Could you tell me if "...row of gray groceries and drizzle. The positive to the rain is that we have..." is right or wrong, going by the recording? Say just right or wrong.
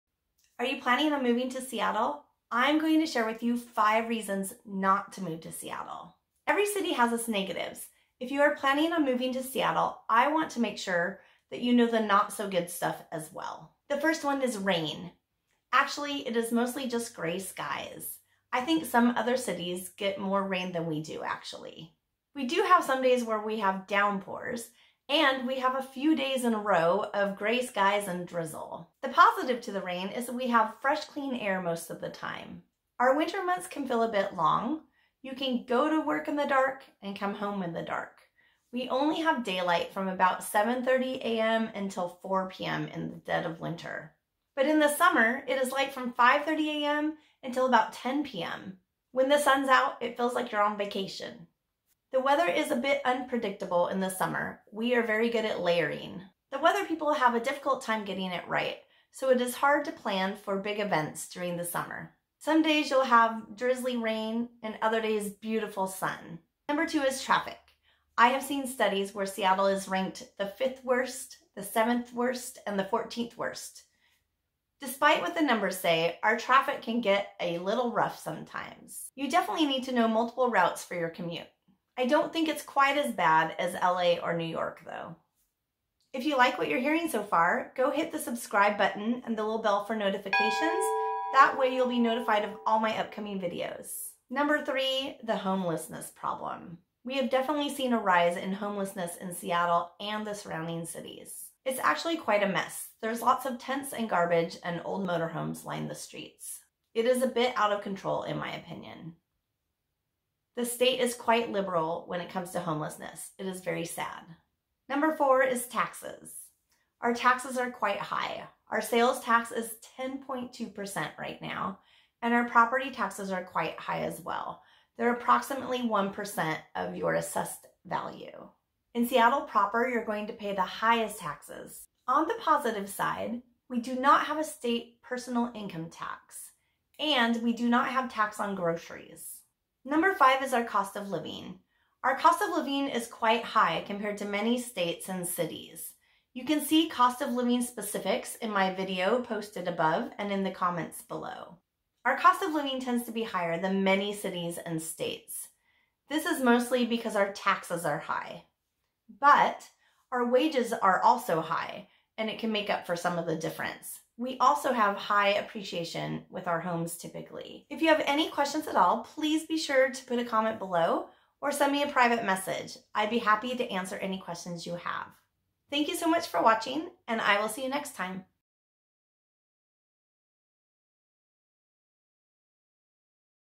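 wrong.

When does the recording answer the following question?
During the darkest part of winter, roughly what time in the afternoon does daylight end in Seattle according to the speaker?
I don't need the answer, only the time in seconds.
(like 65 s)
42 s.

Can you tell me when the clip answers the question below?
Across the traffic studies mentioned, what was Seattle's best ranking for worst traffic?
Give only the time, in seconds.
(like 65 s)
72 s.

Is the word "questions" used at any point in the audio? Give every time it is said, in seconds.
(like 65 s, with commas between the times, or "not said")
168 s, 174 s.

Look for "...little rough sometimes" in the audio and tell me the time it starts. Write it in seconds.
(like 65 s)
77 s.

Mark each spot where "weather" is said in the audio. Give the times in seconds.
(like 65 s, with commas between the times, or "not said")
52 s, 56 s.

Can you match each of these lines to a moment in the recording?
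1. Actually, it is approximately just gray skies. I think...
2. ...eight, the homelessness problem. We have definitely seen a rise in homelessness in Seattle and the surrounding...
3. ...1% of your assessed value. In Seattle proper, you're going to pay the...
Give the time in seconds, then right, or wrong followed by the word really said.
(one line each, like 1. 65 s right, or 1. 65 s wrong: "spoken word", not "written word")
1. 15 s wrong: "mostly", not "approximately"
2. 94 s wrong: "three", not "eight"
3. 125 s right.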